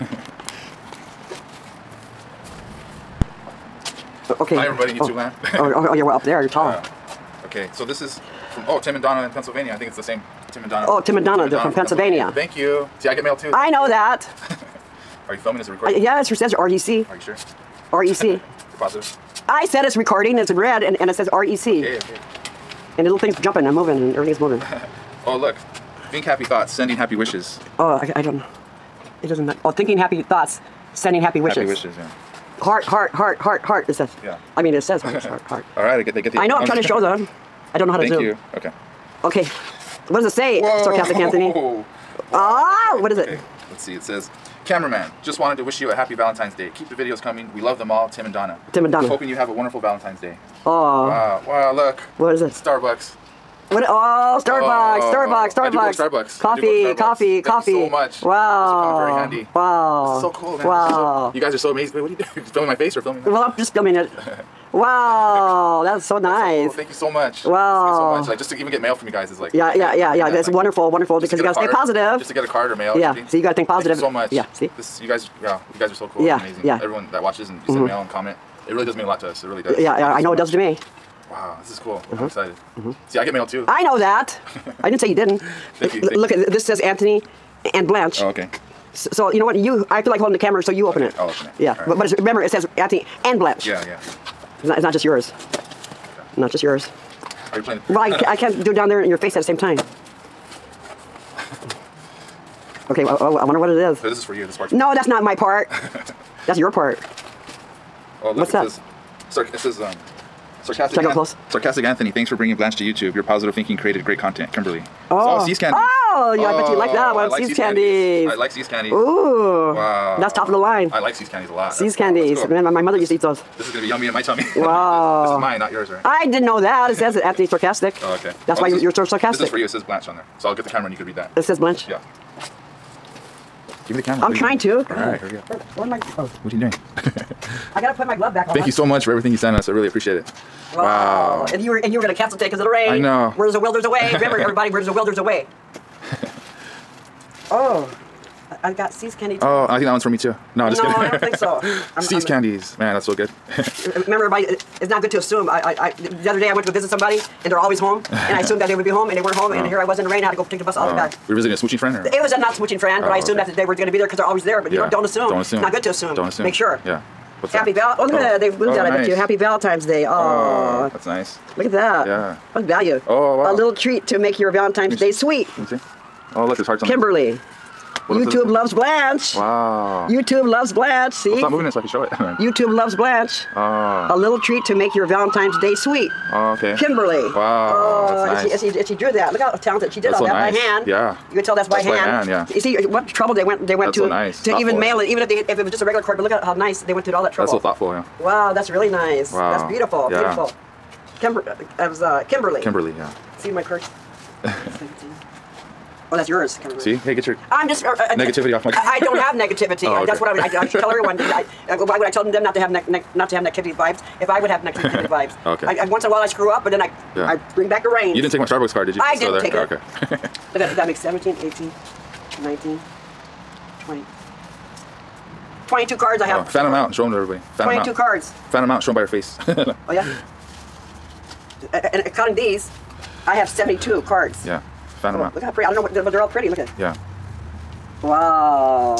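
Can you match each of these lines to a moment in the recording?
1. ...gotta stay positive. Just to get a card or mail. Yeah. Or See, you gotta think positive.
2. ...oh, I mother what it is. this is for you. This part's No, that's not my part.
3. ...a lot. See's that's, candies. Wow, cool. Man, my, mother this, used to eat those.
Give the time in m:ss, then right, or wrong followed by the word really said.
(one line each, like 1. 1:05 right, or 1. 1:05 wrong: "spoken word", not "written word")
1. 1:11 right
2. 1:43 wrong: "wonder", not "mother"
3. 2:01 right.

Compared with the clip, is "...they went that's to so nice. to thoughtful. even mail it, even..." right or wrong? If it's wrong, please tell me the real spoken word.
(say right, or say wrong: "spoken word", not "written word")
right.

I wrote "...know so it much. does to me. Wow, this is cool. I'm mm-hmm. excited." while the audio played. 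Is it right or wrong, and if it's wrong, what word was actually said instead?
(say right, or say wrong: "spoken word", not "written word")
right.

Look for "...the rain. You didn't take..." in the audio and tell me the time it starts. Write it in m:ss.
3:37.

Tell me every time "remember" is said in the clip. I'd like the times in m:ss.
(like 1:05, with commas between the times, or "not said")
1:32, 2:24, 2:34.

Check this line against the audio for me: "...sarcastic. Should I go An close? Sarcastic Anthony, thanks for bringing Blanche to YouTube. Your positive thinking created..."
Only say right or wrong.
right.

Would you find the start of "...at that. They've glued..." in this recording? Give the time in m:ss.
2:48.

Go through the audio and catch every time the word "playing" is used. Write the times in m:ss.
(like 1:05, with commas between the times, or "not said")
1:37.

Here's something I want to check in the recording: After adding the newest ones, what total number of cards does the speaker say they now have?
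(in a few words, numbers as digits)
72.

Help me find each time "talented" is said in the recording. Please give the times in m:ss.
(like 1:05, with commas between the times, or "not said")
3:09.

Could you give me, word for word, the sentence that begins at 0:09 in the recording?
I think it's the same Tim and Donna.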